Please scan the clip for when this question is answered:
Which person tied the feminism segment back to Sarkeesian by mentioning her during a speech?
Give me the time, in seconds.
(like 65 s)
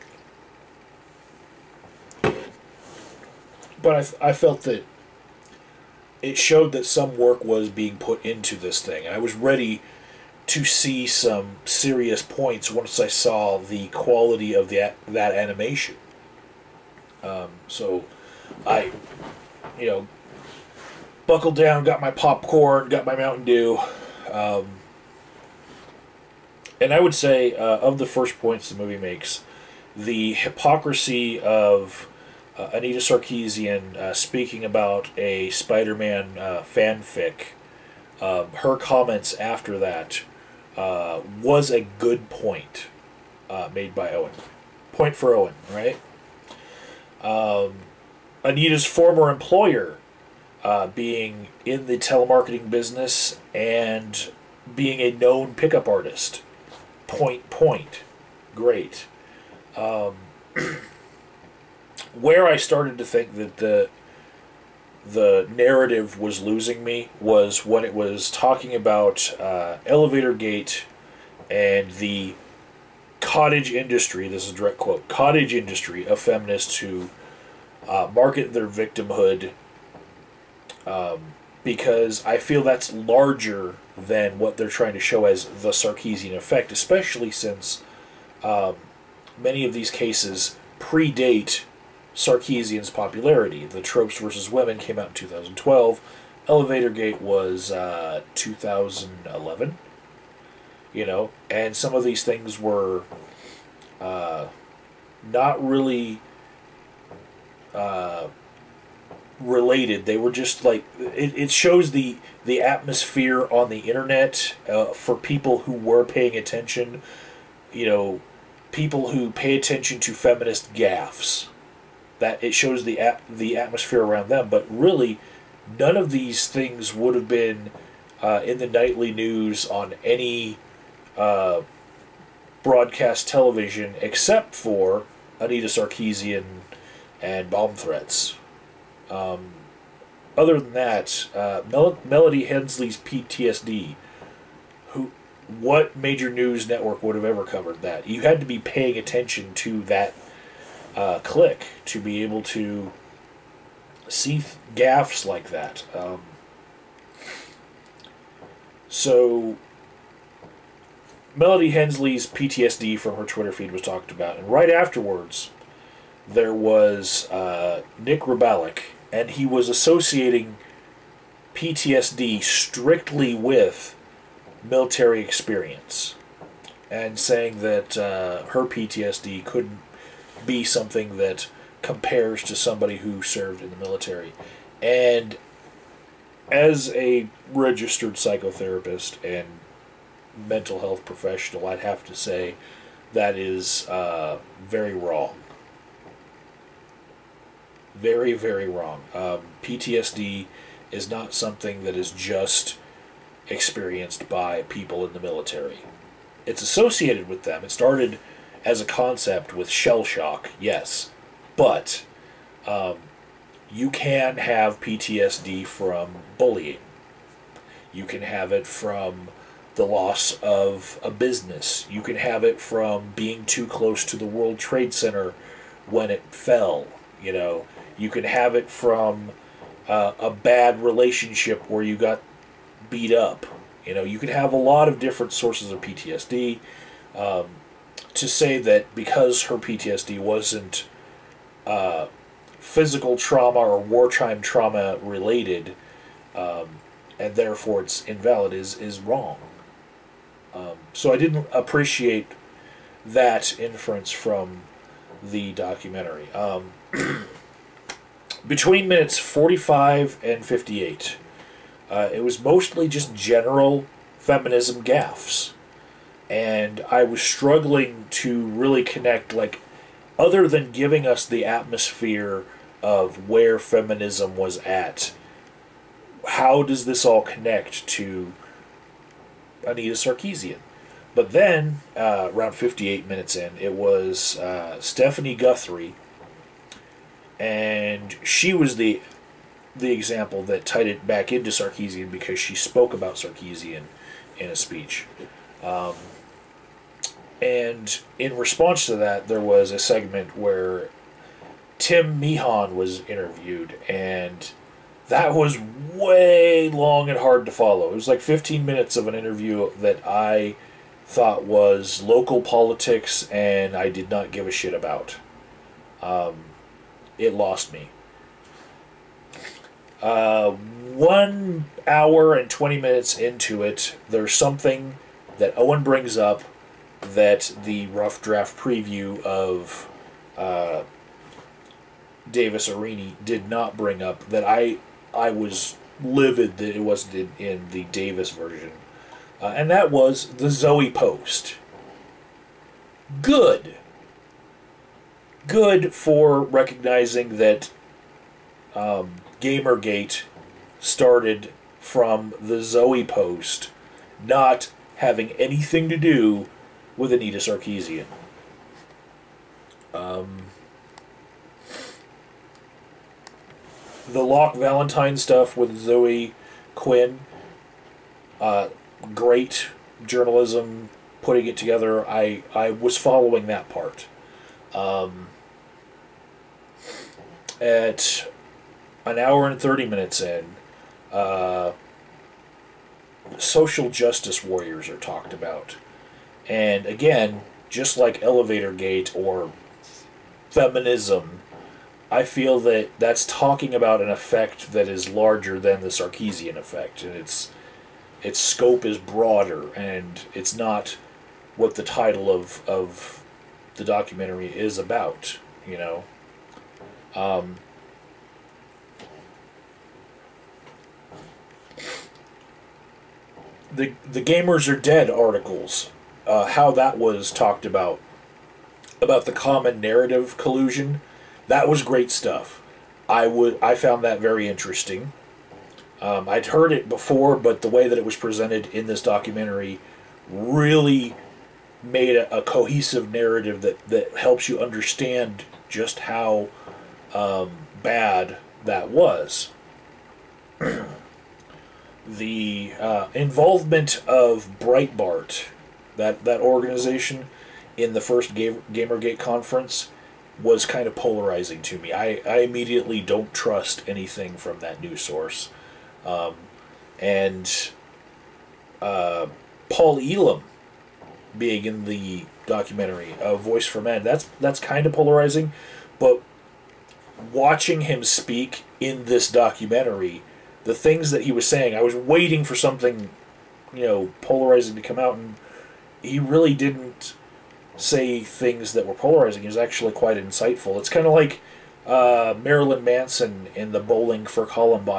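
284 s.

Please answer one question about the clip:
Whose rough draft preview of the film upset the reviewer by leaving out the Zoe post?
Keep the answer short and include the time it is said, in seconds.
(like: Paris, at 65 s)
Davis Aurini, at 332 s.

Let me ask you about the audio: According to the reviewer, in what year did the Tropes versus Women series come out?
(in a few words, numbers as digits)
2012.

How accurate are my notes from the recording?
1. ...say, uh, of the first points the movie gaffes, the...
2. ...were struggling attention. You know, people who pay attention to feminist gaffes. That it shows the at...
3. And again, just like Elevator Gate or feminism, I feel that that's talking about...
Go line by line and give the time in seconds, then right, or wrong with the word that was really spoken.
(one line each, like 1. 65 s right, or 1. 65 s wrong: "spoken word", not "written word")
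1. 27 s wrong: "makes", not "gaffes"
2. 115 s wrong: "paying", not "struggling"
3. 386 s right.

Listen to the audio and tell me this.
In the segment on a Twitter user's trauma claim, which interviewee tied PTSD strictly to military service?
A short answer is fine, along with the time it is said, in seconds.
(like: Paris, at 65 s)
Nick Rubalik, at 167 s.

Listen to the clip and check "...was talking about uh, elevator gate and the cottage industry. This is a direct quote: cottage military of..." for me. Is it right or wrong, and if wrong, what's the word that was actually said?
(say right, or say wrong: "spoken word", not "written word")
wrong: "industry", not "military".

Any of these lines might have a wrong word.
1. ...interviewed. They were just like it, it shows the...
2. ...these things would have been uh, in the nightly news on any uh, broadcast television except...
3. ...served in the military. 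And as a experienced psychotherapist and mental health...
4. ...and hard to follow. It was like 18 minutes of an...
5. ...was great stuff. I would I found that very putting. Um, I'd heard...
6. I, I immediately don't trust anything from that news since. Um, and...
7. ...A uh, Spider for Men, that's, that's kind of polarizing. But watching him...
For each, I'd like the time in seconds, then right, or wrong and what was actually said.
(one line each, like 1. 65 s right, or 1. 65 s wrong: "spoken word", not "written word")
1. 109 s wrong: "related", not "interviewed"
2. 126 s right
3. 183 s wrong: "registered", not "experienced"
4. 307 s wrong: "15", not "18"
5. 421 s wrong: "interesting", not "putting"
6. 451 s wrong: "source", not "since"
7. 463 s wrong: "Voice", not "Spider".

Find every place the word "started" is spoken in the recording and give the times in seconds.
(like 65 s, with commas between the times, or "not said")
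62 s, 207 s, 350 s.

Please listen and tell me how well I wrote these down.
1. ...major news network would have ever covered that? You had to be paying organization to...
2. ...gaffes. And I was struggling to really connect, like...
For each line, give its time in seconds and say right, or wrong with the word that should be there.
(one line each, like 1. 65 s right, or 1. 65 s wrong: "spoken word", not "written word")
1. 145 s wrong: "attention", not "organization"
2. 264 s right.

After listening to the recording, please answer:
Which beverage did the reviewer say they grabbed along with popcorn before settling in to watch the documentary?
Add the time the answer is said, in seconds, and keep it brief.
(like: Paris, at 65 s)
Mountain Dew, at 23 s.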